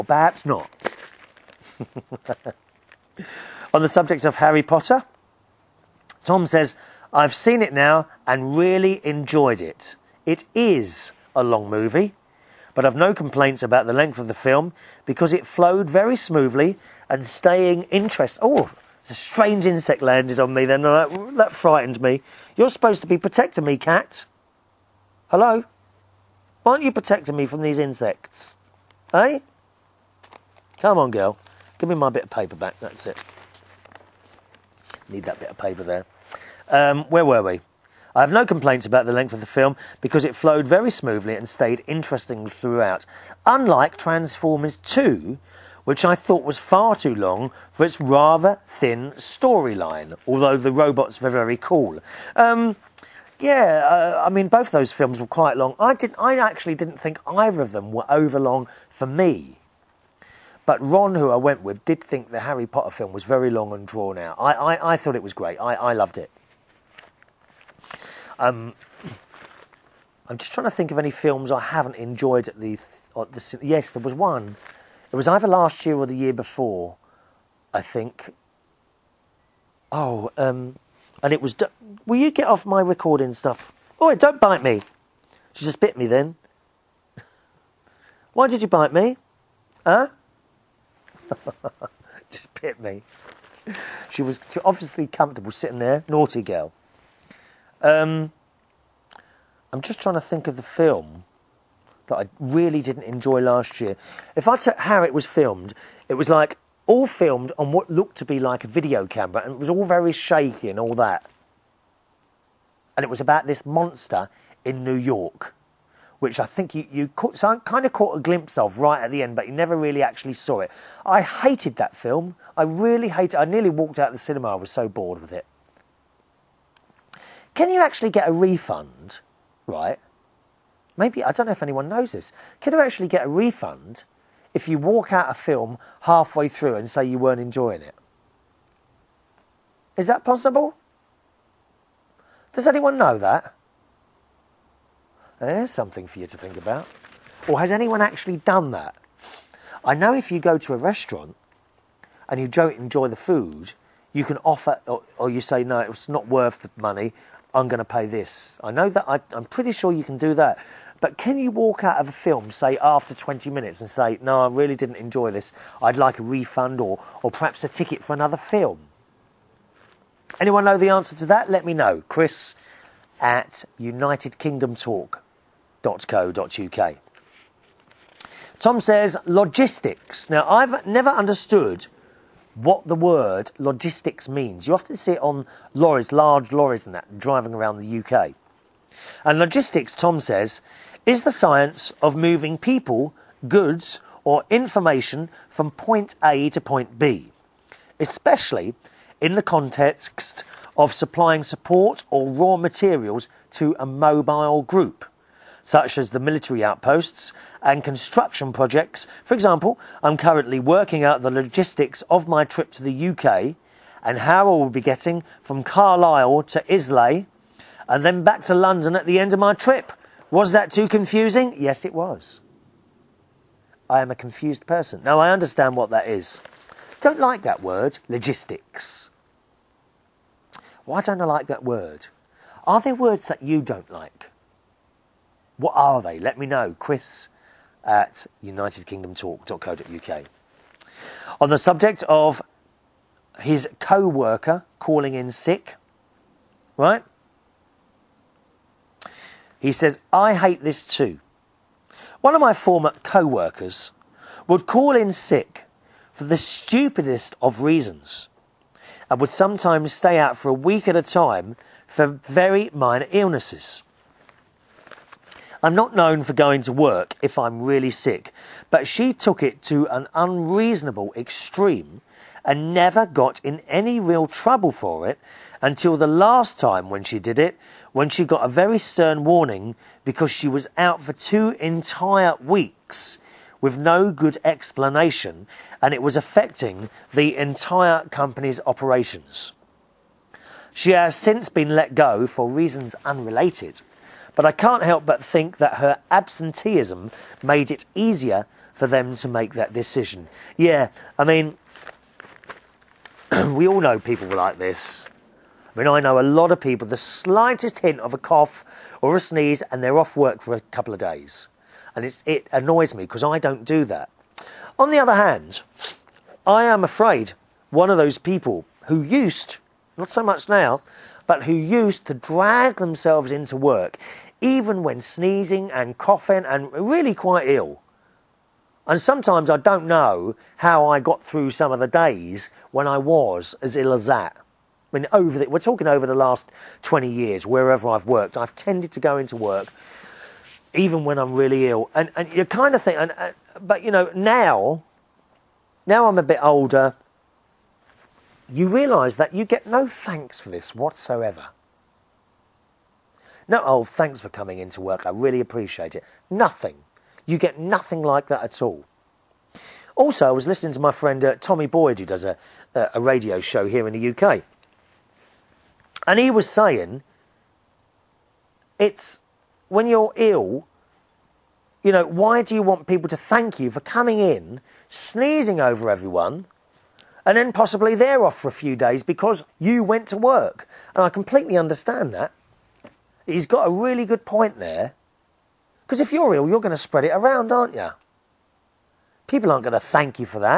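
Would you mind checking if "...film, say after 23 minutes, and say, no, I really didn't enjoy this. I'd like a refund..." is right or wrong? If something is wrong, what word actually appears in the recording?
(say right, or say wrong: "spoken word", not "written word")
wrong: "20", not "23".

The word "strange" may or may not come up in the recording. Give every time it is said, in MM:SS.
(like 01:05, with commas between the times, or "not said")
00:19.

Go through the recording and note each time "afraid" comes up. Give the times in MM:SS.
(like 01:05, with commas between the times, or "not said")
05:16.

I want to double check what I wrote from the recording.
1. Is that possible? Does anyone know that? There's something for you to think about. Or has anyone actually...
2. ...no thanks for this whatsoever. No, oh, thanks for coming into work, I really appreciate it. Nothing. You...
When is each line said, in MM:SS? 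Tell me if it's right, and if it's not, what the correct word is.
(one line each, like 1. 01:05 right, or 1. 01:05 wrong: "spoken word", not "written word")
1. 02:19 right
2. 05:49 right.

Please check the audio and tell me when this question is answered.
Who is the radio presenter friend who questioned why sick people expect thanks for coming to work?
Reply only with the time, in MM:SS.
06:01.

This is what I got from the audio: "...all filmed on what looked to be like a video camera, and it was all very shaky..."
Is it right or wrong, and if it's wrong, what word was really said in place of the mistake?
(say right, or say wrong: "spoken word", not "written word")
right.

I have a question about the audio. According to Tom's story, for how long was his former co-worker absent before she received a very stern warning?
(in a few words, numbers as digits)
2 weeks.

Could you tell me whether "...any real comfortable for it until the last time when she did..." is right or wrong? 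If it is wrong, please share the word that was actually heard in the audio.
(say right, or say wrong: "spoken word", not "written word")
wrong: "trouble", not "comfortable".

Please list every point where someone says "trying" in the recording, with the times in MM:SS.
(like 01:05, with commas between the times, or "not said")
01:10, 01:40.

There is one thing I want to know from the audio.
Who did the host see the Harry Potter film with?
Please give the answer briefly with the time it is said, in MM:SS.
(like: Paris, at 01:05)
Ron, at 01:00.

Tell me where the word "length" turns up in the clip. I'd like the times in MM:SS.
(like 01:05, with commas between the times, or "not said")
00:13, 00:39.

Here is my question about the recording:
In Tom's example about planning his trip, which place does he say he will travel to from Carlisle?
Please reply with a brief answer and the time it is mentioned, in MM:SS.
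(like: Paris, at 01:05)
Islay, at 03:36.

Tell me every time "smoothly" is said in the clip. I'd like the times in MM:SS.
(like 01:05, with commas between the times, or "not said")
00:16, 00:40.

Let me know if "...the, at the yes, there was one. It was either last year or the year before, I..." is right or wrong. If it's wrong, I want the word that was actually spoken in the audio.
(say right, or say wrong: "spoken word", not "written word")
right.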